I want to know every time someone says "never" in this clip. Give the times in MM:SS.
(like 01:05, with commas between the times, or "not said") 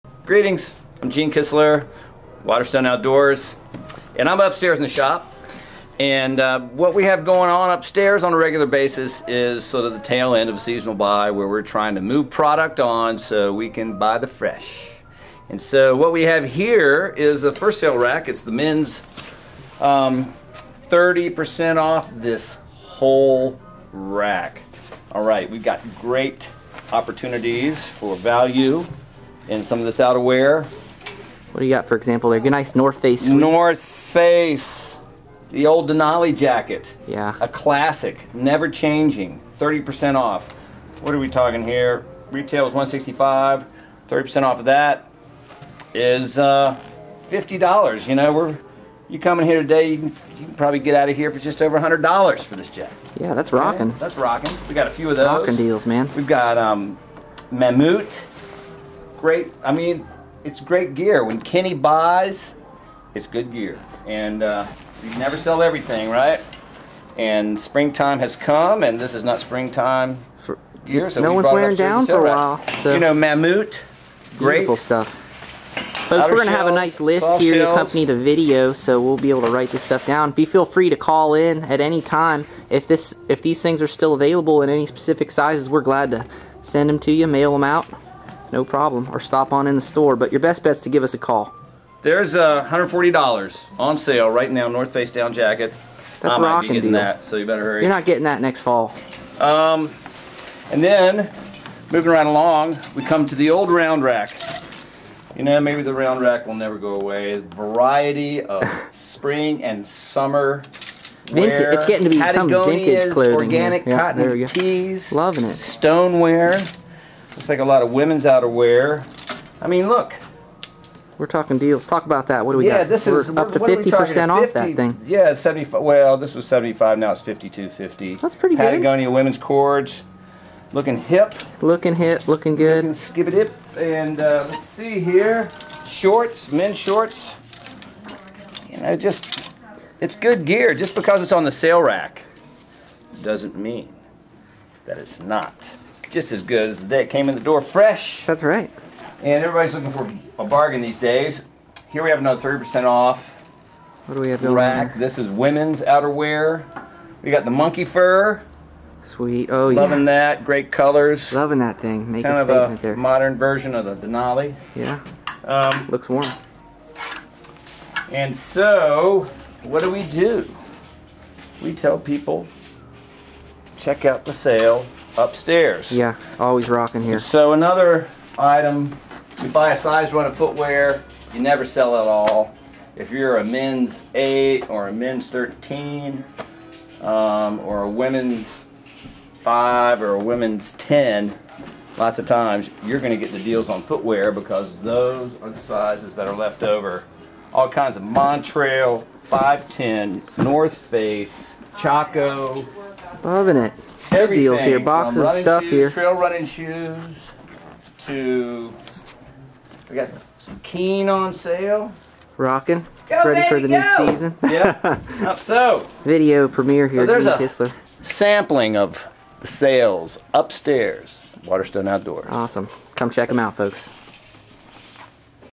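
00:38, 01:05, 01:46, 03:01.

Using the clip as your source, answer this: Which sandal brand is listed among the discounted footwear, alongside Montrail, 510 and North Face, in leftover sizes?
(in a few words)
Chaco.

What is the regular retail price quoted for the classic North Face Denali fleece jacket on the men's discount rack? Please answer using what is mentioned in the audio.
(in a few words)
$165.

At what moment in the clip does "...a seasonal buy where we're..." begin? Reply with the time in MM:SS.
00:10.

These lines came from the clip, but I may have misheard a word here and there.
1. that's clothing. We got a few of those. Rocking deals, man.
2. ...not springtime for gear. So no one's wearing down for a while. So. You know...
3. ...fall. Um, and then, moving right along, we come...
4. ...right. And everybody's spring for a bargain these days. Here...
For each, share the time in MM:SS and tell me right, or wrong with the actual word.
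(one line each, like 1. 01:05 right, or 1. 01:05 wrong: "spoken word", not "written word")
1. 00:53 wrong: "rocking", not "clothing"
2. 01:09 right
3. 01:38 right
4. 02:28 wrong: "looking", not "spring".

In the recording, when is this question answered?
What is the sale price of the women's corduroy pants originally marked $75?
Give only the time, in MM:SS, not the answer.
02:07.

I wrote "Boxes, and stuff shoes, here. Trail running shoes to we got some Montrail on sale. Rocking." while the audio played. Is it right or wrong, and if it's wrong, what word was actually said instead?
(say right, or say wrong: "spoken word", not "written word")
wrong: "Keen", not "Montrail".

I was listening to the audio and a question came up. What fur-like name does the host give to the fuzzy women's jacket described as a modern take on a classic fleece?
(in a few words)
monkey fur.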